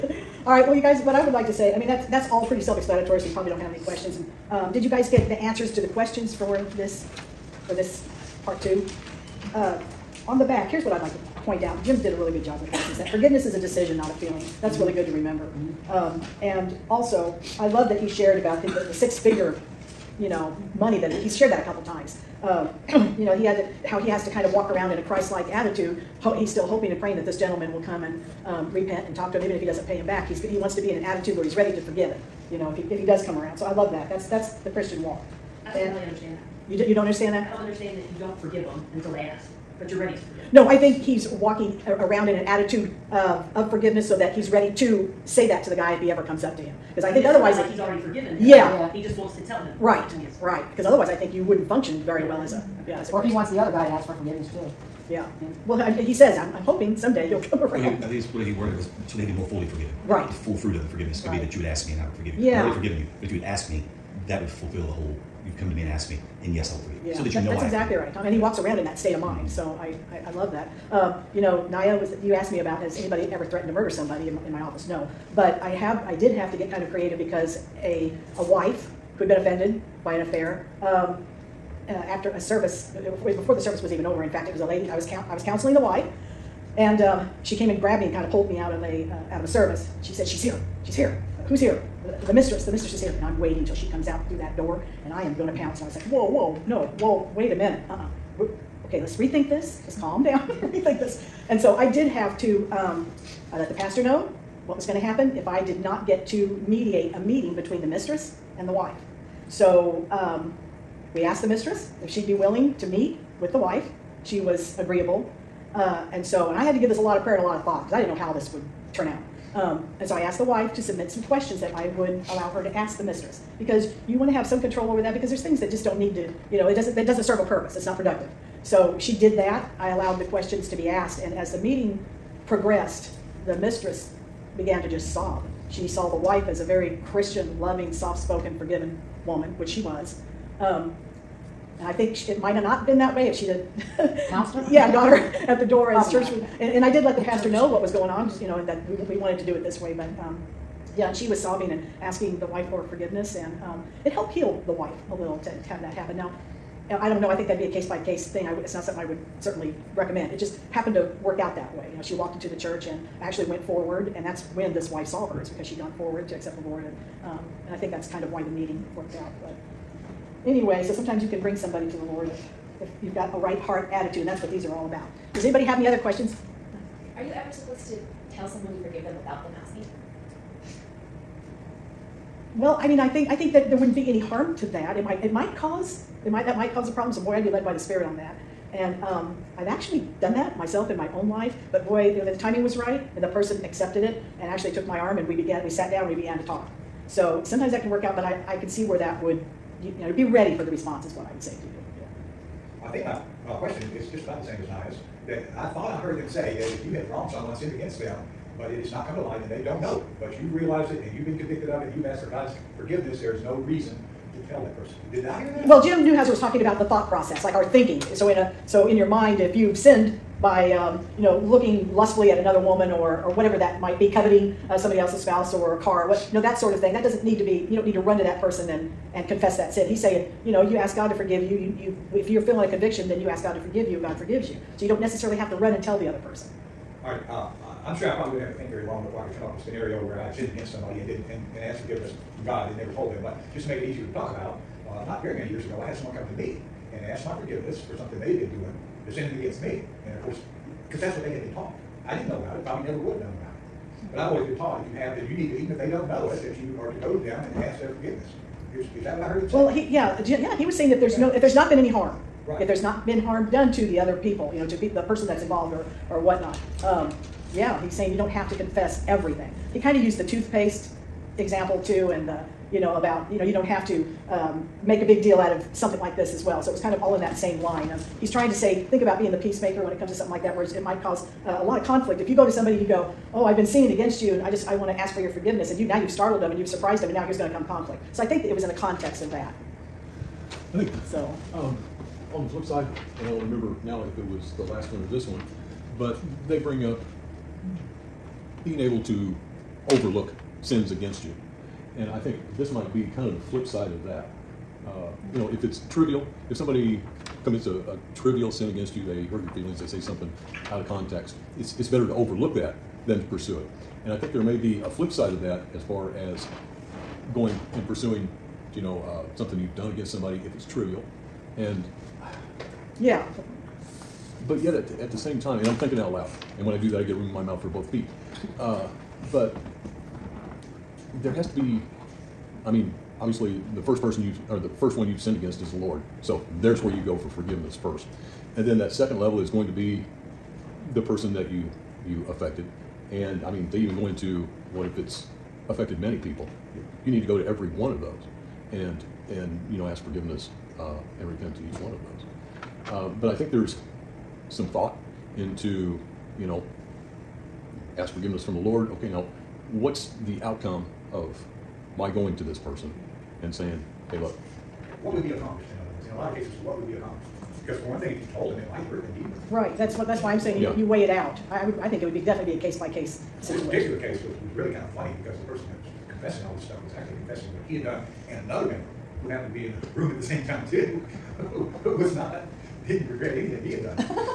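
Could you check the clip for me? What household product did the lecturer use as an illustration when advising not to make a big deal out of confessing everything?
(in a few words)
Toothpaste.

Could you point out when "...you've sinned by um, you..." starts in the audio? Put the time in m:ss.
3:39.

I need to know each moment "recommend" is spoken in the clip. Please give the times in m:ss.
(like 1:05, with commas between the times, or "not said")
2:39.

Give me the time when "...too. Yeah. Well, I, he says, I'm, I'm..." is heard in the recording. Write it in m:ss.
0:54.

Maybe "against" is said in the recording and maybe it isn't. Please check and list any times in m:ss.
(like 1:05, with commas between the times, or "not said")
3:27, 4:00, 4:09, 4:43, 5:00, 5:08, 5:19, 5:35.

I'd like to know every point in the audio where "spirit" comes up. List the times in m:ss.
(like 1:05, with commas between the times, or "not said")
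3:07.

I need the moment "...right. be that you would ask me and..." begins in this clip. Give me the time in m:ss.
1:01.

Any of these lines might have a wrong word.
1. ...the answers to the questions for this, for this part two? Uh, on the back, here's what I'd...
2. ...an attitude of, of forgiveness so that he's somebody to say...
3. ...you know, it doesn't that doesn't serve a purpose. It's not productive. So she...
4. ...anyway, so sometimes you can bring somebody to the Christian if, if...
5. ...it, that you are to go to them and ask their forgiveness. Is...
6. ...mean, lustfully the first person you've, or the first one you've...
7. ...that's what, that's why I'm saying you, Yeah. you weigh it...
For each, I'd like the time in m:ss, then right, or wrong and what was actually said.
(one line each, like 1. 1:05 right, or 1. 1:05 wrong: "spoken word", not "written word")
1. 0:05 right
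2. 0:42 wrong: "ready", not "somebody"
3. 2:06 right
4. 2:50 wrong: "Lord", not "Christian"
5. 4:16 right
6. 5:32 wrong: "obviously", not "lustfully"
7. 6:09 right.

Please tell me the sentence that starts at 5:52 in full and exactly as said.
Uh, but I think there's some thought into, you know, ask forgiveness from the Lord.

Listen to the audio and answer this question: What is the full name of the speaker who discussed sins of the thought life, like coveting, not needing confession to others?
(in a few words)
Jim Newheiser.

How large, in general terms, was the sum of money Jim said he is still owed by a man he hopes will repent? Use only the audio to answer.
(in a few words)
Six-figure.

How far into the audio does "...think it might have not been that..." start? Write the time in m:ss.
2:21.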